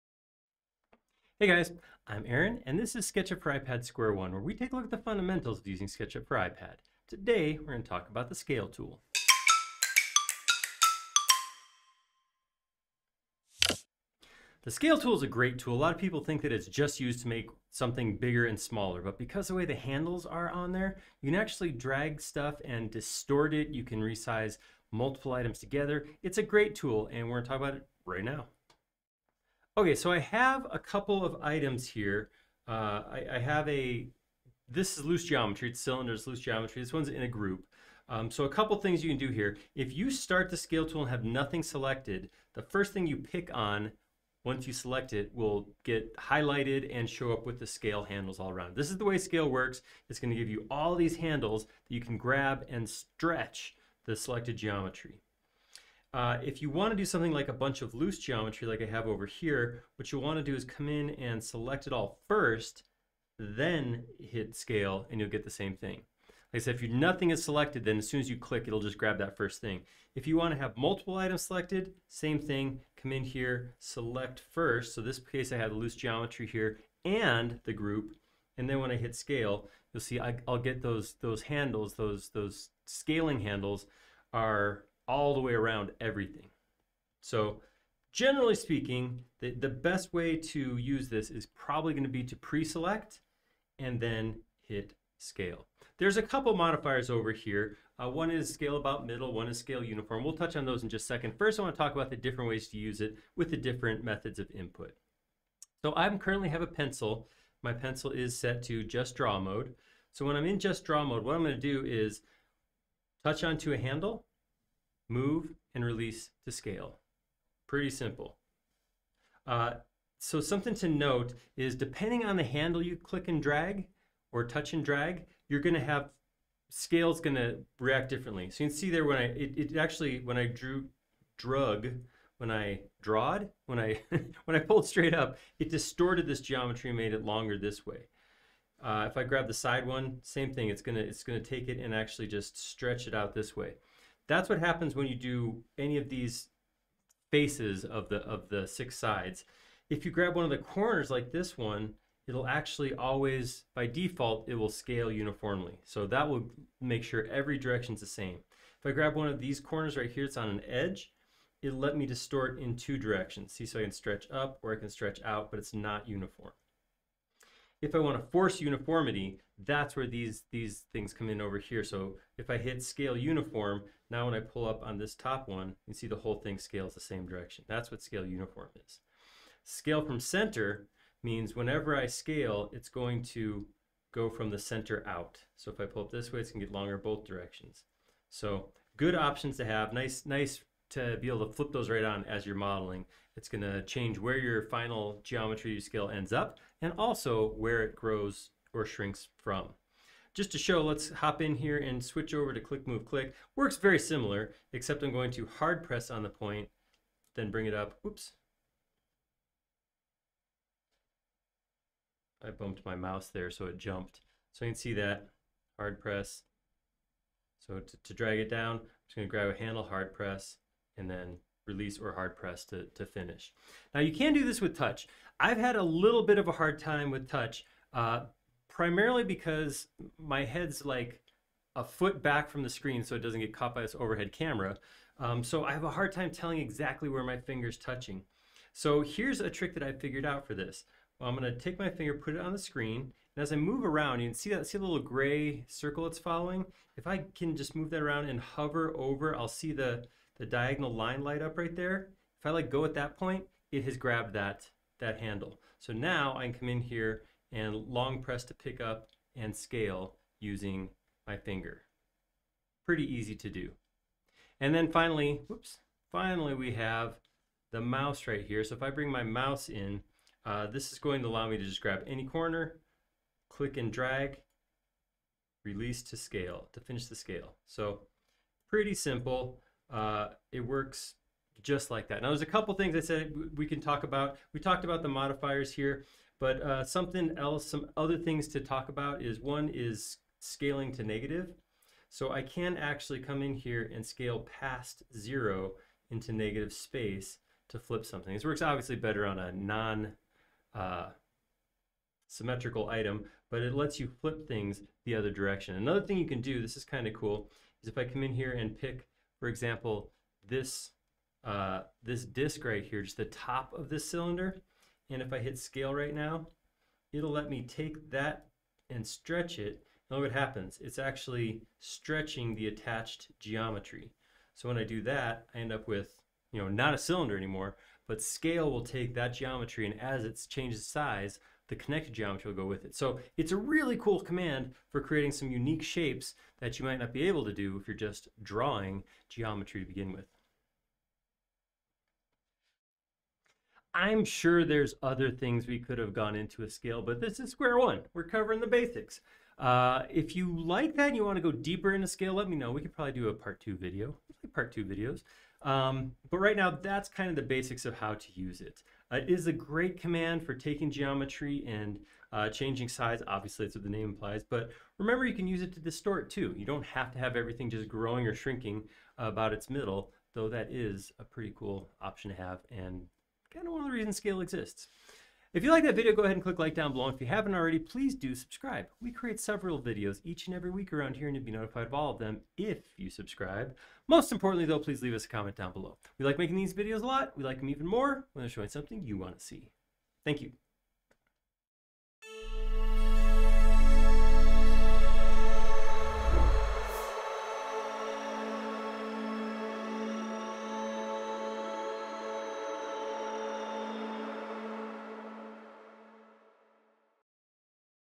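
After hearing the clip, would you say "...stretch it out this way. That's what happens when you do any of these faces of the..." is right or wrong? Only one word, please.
right.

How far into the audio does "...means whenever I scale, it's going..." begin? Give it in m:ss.
3:01.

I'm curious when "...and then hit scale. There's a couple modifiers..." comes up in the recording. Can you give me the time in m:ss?
1:33.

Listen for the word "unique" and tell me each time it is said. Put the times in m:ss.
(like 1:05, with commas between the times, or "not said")
5:35.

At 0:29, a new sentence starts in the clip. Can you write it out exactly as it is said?
Okay, so I have a couple of items here.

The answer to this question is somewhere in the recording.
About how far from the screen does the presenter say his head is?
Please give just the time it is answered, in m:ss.
3:51.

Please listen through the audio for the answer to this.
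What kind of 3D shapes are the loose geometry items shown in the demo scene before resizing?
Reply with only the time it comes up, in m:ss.
0:35.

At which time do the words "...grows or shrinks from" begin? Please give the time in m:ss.
3:17.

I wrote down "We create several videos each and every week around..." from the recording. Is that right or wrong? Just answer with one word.
right.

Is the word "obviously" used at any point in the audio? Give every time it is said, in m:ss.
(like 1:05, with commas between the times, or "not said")
4:58, 6:03.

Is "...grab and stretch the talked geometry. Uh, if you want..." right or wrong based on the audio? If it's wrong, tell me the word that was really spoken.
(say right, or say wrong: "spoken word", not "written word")
wrong: "selected", not "talked".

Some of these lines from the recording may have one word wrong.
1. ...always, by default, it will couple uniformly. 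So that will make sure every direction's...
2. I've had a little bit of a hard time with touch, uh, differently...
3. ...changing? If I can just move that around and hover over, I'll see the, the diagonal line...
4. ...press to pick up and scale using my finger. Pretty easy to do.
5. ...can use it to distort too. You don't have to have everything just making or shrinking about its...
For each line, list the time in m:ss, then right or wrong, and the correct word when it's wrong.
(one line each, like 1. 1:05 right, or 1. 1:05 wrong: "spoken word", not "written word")
1. 2:32 wrong: "scale", not "couple"
2. 3:45 wrong: "primarily", not "differently"
3. 4:06 wrong: "following", not "changing"
4. 4:18 right
5. 6:05 wrong: "growing", not "making".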